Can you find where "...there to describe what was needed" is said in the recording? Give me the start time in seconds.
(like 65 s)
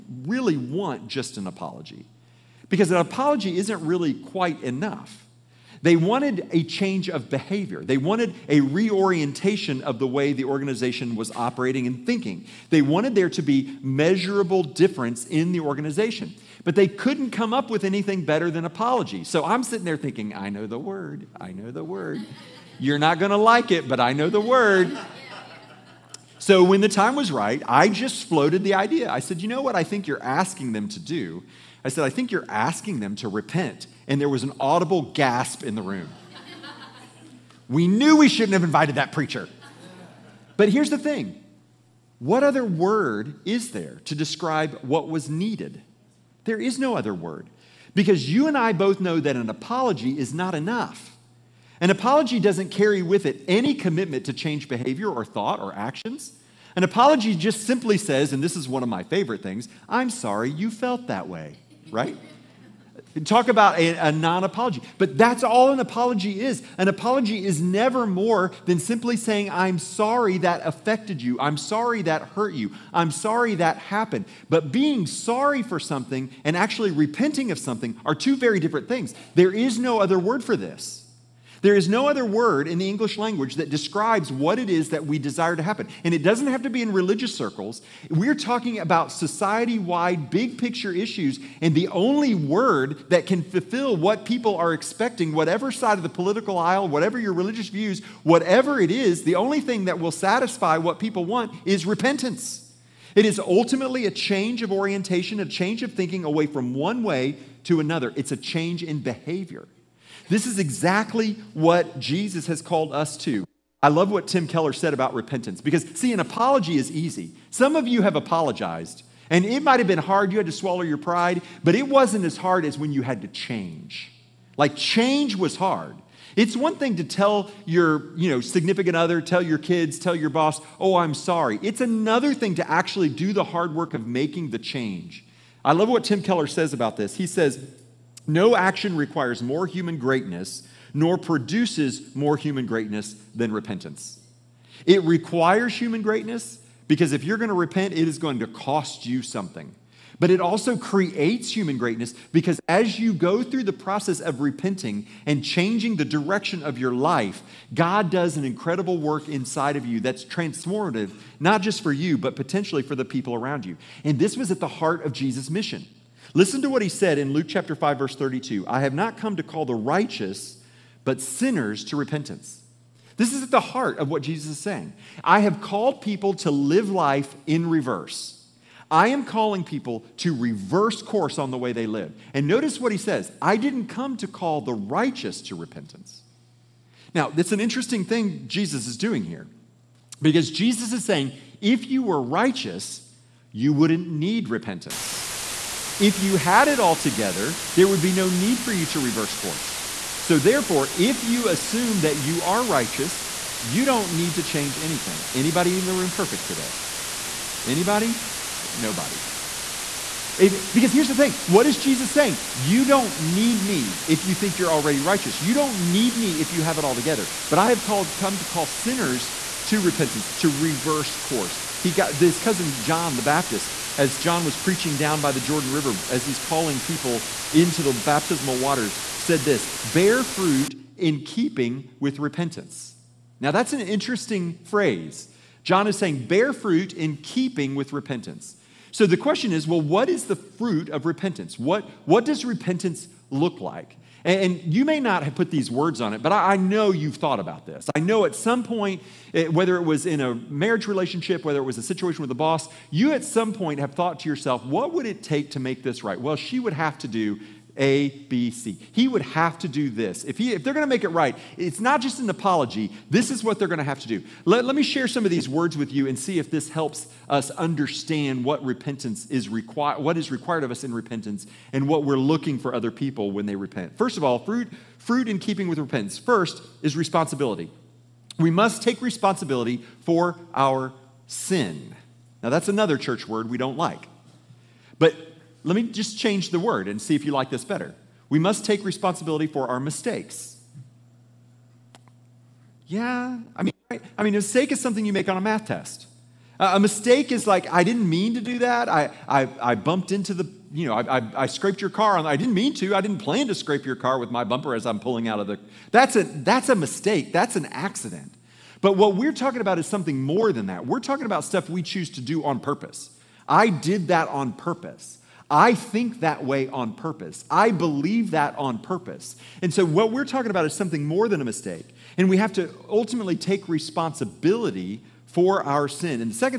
43 s.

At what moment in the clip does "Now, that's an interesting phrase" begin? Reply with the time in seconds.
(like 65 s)
233 s.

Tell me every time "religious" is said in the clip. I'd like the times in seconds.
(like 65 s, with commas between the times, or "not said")
86 s, 97 s.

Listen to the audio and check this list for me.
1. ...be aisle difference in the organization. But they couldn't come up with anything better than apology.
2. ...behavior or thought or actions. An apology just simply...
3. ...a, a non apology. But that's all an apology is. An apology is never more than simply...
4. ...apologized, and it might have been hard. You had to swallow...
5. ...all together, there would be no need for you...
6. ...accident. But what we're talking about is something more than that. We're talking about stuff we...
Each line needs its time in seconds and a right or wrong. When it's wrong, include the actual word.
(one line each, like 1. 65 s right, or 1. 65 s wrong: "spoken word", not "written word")
1. 13 s wrong: "measurable", not "aisle"
2. 54 s right
3. 63 s right
4. 118 s right
5. 196 s right
6. 307 s right.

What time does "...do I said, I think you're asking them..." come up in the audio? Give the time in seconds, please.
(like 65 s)
30 s.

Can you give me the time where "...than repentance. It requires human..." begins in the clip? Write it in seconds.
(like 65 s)
143 s.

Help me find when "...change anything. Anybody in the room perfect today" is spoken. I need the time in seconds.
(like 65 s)
204 s.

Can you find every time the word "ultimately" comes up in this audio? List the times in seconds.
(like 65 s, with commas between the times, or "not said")
103 s, 322 s.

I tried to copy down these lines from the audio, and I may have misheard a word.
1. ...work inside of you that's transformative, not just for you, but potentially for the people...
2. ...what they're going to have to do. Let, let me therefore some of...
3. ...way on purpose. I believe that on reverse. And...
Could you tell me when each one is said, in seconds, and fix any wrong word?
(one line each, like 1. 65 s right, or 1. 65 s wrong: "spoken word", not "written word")
1. 158 s right
2. 263 s wrong: "share", not "therefore"
3. 316 s wrong: "purpose", not "reverse".